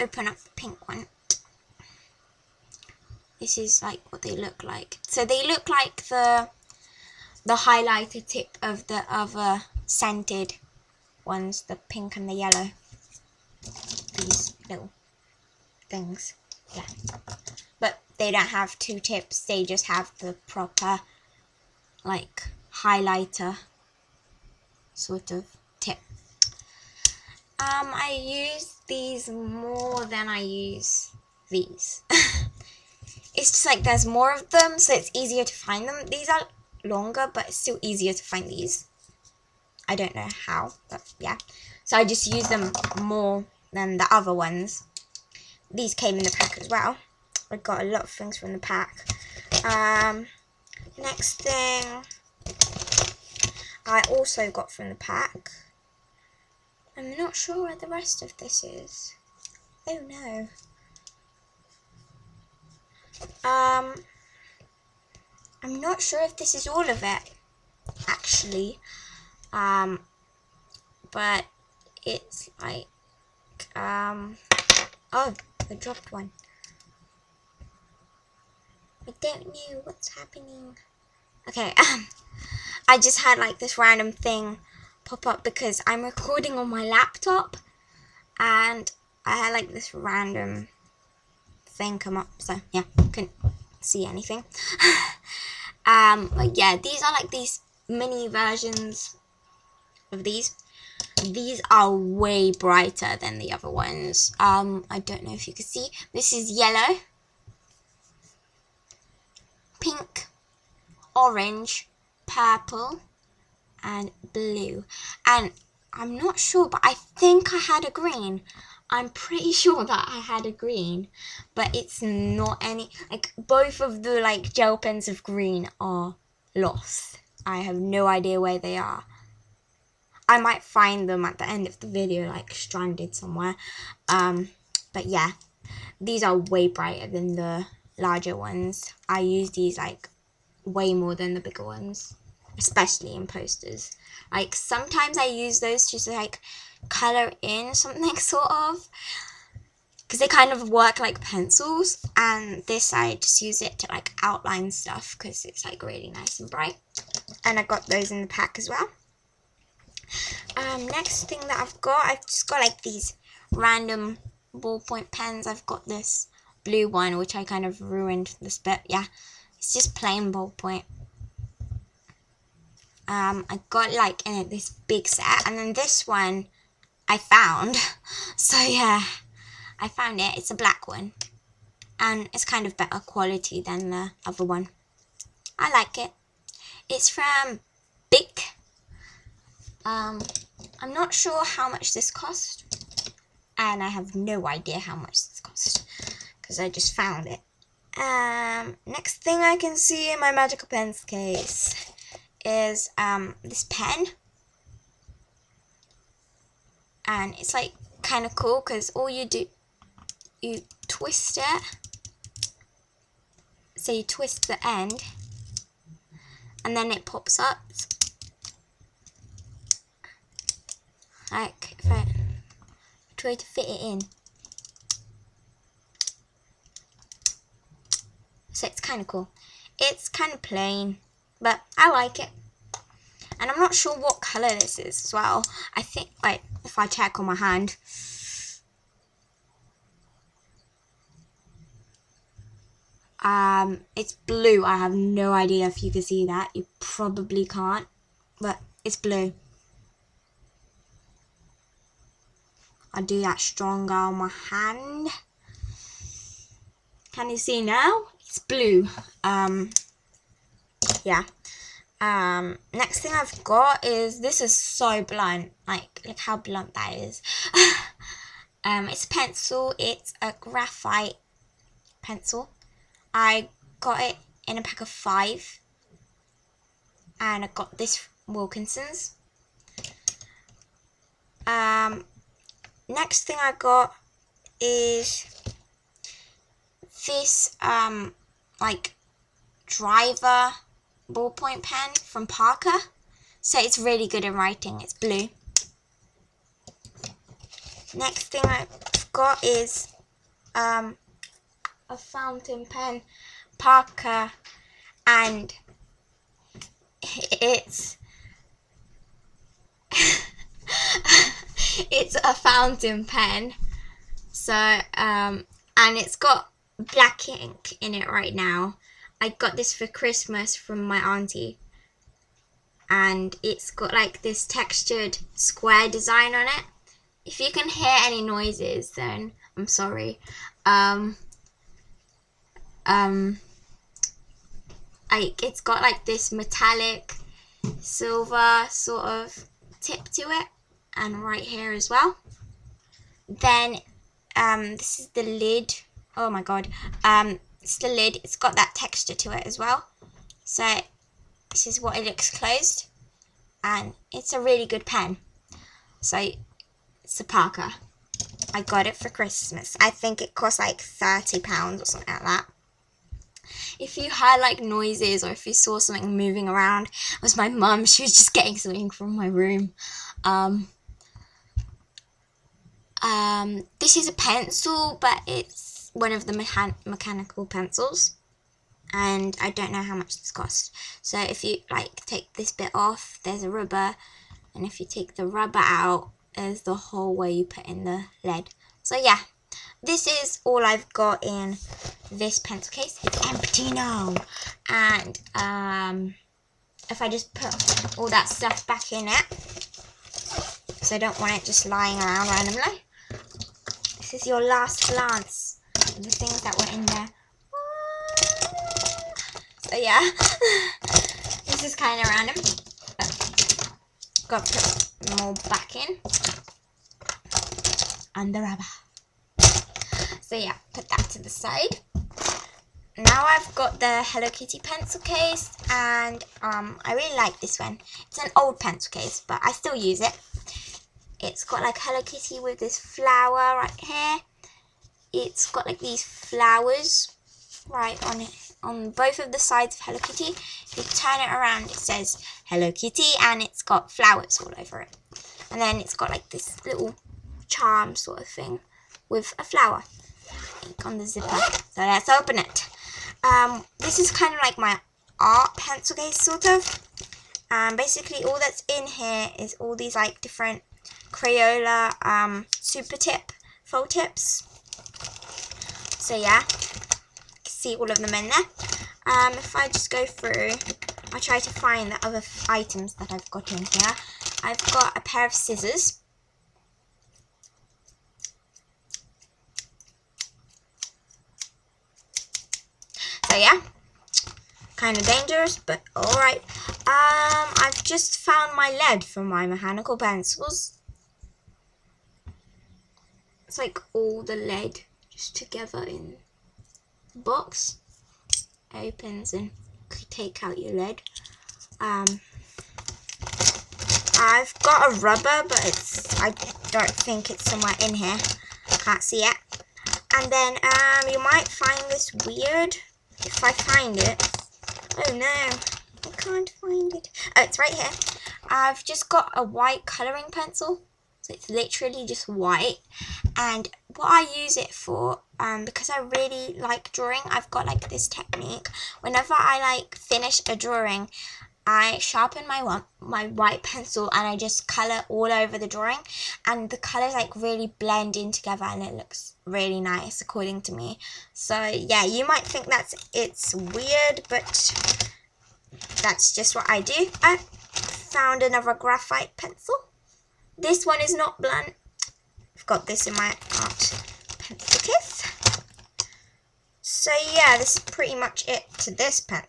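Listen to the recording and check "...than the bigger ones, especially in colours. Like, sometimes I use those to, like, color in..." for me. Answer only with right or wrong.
wrong.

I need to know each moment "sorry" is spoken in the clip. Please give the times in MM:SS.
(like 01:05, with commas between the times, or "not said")
05:29.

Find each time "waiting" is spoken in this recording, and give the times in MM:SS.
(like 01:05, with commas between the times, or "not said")
not said.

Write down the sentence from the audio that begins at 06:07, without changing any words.
She was just getting something from my room.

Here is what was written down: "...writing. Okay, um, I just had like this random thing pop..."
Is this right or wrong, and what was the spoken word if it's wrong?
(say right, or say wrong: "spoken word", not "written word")
wrong: "happening", not "writing".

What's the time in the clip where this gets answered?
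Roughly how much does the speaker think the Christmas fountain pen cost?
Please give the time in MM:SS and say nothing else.
06:00.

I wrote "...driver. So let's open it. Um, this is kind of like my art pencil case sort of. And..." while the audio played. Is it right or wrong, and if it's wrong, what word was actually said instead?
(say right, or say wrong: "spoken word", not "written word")
wrong: "zipper", not "driver".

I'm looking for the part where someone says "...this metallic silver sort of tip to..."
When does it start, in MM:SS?
05:36.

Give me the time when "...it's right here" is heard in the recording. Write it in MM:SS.
08:37.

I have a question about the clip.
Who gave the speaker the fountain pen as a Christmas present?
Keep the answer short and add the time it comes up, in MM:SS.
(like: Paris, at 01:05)
auntie, at 05:20.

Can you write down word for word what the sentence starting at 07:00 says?
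So yeah, put that to the side.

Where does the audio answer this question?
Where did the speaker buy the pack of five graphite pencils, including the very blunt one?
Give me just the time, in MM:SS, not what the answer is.
04:38.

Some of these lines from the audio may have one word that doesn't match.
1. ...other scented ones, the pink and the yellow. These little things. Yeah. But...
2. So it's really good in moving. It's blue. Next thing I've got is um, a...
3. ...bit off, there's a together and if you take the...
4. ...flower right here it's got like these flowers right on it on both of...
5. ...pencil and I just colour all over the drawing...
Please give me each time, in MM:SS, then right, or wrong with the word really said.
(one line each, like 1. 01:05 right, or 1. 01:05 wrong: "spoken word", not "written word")
1. 00:09 right
2. 04:53 wrong: "writing", not "moving"
3. 06:22 wrong: "rubber", not "together"
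4. 07:12 right
5. 08:53 right.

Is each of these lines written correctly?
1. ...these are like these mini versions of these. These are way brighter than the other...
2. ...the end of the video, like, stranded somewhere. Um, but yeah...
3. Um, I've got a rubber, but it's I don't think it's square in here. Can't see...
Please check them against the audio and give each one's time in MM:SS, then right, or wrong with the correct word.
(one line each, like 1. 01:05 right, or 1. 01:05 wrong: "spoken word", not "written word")
1. 01:36 right
2. 02:11 right
3. 08:21 wrong: "somewhere", not "square".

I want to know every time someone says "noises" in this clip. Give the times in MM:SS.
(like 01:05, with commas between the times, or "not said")
05:28, 06:04.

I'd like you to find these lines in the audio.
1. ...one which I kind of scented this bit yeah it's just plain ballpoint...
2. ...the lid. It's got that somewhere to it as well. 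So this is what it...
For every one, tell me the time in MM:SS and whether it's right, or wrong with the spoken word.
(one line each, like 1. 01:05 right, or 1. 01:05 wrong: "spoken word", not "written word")
1. 02:46 wrong: "ruined", not "scented"
2. 05:47 wrong: "texture", not "somewhere".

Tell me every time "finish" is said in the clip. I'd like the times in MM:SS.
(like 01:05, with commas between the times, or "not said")
08:49.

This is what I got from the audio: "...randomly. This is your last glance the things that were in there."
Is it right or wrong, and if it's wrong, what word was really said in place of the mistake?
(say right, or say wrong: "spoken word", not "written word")
right.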